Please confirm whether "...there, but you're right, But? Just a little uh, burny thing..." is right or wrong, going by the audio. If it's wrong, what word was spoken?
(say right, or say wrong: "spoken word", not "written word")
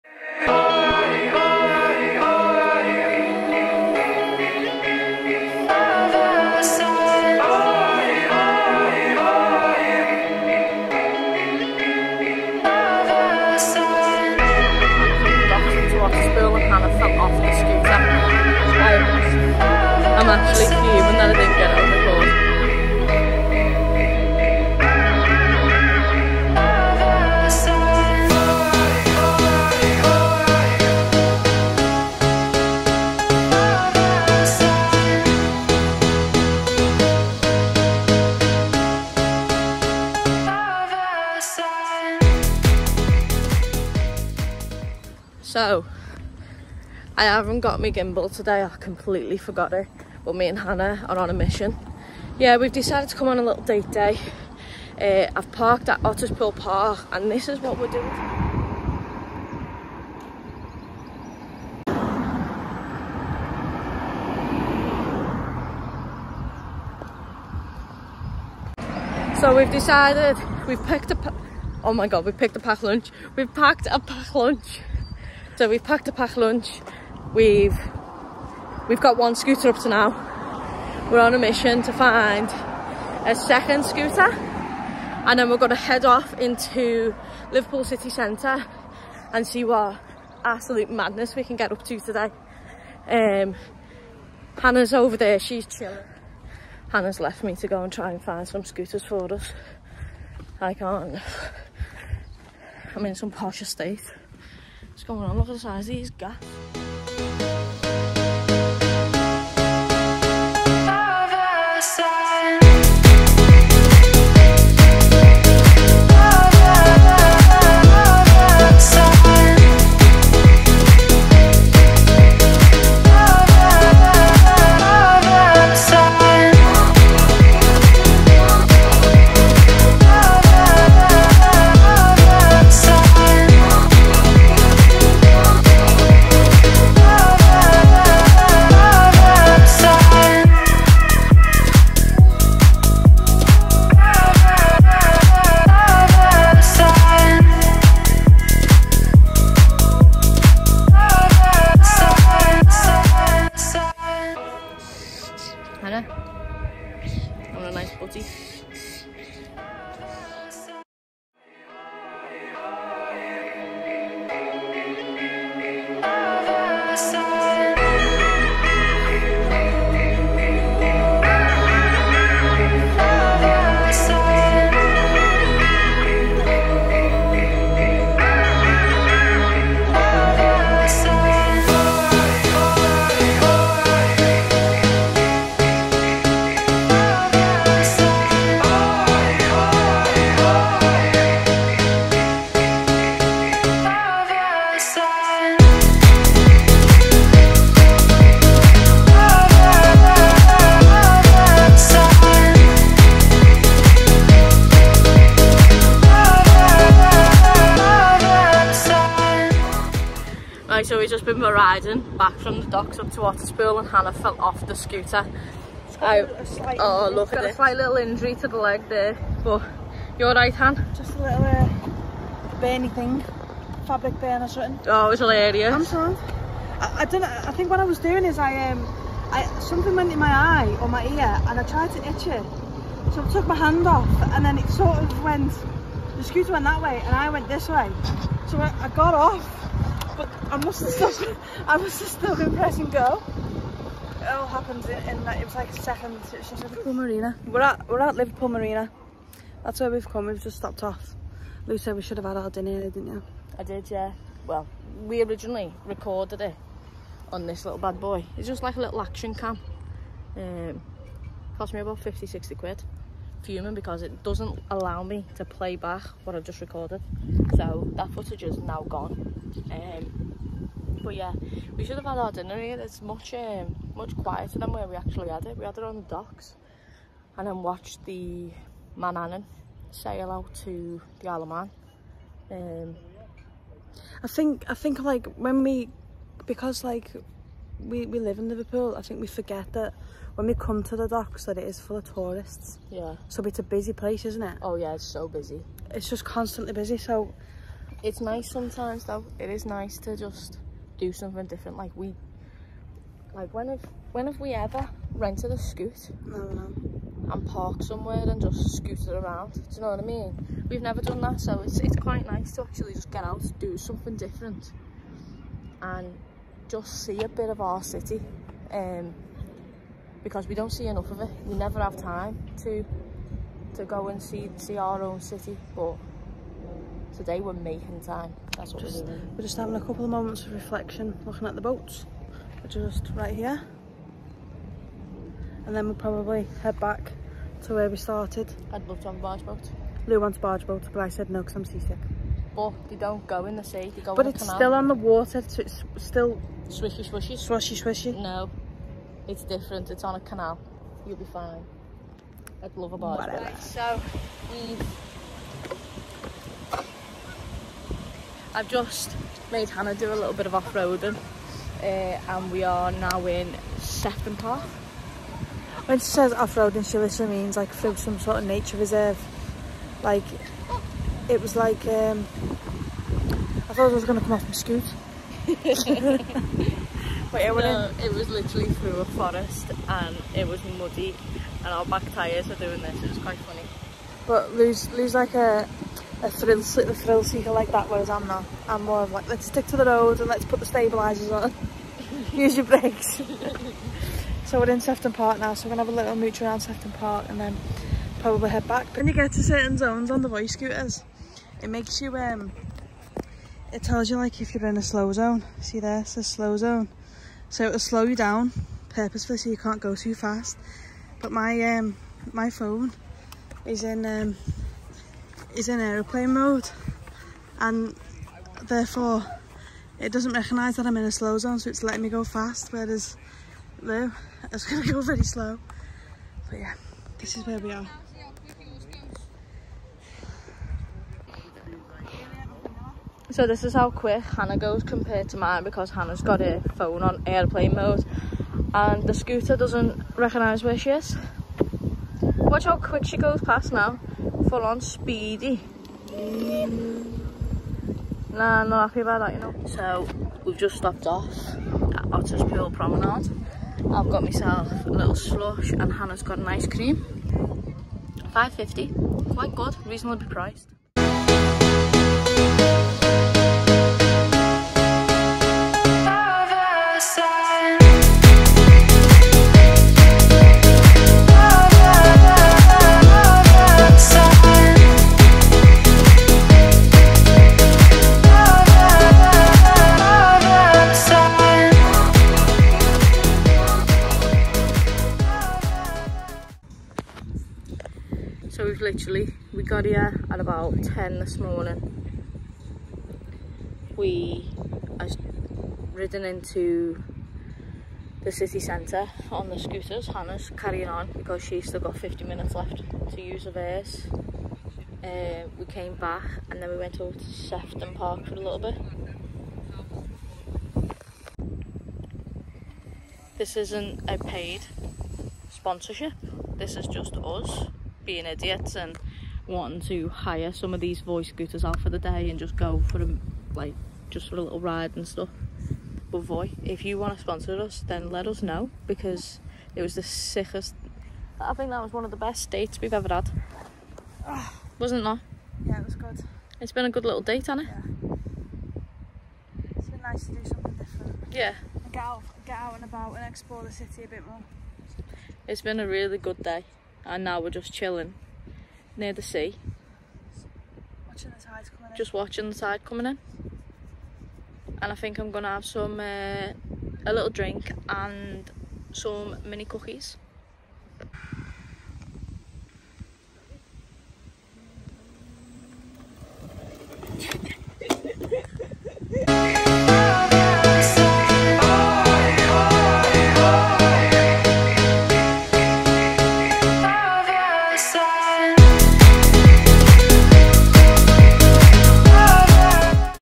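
wrong: "Han", not "But".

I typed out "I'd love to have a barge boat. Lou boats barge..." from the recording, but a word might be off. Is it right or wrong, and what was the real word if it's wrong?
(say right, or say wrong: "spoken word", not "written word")
wrong: "wants", not "boats".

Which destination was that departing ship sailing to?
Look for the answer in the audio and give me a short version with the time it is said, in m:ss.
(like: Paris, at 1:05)
Isle of Man, at 4:41.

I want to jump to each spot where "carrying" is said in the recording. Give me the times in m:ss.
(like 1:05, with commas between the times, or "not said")
8:20.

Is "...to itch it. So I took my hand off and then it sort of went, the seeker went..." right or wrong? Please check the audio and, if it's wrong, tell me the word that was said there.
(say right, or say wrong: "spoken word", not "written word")
wrong: "scooter", not "seeker".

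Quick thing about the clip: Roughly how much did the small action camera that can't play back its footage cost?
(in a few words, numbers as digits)
50-60 quid.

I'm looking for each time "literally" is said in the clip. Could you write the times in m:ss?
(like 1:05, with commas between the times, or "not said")
6:06, 6:18.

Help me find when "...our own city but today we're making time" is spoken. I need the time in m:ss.
5:24.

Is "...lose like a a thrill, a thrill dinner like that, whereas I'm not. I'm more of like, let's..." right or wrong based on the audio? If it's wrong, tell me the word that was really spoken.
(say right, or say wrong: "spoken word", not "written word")
wrong: "seeker", not "dinner".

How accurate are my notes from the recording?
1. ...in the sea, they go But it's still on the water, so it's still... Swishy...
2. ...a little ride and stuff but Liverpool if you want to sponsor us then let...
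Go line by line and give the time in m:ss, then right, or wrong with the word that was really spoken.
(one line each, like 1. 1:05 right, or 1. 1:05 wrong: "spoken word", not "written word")
1. 5:43 right
2. 8:44 wrong: "Voi", not "Liverpool".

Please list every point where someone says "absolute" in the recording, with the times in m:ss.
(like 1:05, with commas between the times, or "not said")
1:30.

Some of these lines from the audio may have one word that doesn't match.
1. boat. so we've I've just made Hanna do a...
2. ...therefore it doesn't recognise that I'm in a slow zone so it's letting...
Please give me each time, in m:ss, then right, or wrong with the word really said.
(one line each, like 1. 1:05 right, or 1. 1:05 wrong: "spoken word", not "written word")
1. 5:53 right
2. 6:58 right.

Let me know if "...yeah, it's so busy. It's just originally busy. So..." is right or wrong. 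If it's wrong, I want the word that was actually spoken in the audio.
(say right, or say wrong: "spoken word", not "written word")
wrong: "constantly", not "originally".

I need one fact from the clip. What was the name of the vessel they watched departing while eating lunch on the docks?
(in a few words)
Manannan.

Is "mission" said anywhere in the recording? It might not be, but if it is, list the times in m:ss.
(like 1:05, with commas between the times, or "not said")
0:51, 1:21.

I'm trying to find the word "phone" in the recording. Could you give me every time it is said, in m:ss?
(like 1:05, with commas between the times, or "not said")
6:52, 7:16.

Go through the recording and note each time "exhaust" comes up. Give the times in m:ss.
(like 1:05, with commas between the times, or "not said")
not said.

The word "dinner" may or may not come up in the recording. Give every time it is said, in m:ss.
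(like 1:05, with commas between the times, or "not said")
4:12, 4:32.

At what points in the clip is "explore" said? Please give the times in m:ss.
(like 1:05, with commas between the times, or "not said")
9:03.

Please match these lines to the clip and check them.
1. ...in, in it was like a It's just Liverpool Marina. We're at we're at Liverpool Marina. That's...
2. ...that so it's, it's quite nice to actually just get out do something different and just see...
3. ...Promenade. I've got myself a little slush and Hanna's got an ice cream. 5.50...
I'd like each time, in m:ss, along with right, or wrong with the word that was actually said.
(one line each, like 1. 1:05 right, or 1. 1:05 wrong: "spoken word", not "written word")
1. 4:04 right
2. 5:11 right
3. 7:32 right.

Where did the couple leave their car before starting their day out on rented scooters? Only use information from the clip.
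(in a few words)
Otterspool Park.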